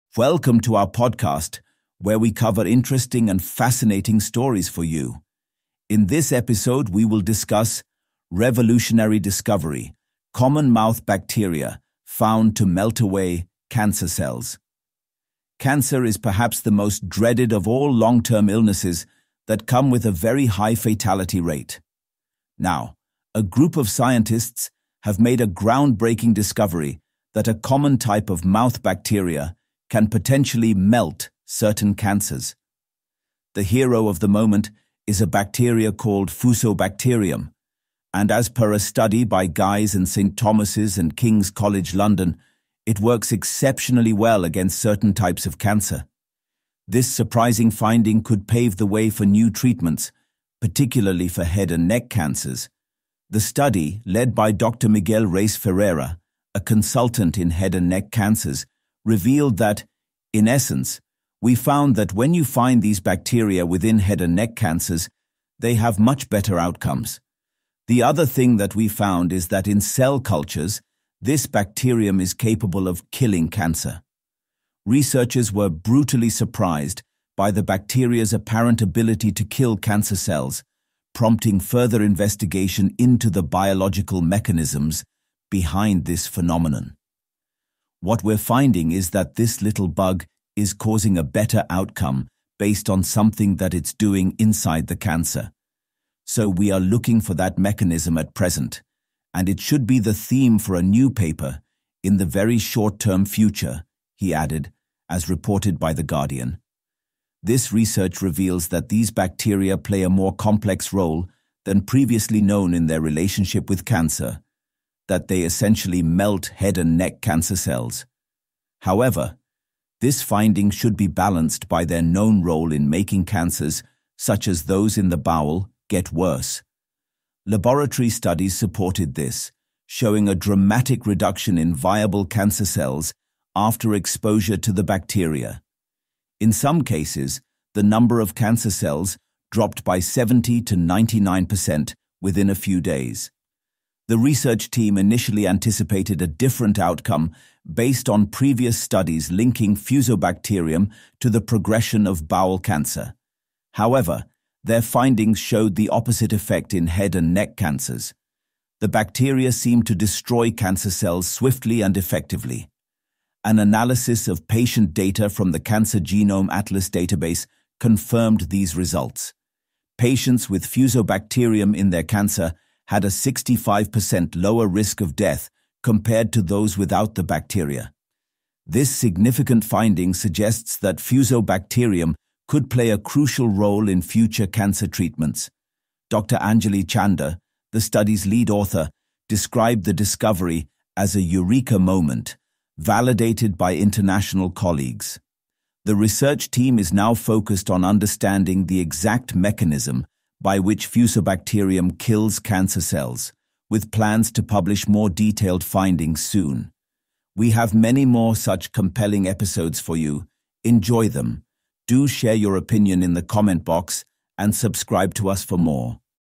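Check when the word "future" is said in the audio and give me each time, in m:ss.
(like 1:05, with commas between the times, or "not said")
1:43, 3:04.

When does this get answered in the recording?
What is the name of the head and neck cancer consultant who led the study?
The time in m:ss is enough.
0:54.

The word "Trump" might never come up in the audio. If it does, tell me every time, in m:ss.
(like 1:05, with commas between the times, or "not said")
not said.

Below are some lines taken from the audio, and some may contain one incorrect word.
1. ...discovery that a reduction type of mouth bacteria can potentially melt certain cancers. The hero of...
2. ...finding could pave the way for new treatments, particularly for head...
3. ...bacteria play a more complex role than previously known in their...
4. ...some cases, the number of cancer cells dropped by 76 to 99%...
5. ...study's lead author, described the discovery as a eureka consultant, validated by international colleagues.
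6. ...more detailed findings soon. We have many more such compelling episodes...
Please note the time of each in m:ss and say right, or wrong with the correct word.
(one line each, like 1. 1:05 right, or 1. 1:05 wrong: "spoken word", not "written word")
1. 0:26 wrong: "common", not "reduction"
2. 0:47 right
3. 1:49 right
4. 2:16 wrong: "70", not "76"
5. 3:07 wrong: "moment", not "consultant"
6. 3:24 right.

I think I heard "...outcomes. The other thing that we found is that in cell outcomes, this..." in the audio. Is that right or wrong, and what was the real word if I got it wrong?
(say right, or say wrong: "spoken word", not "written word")
wrong: "cultures", not "outcomes".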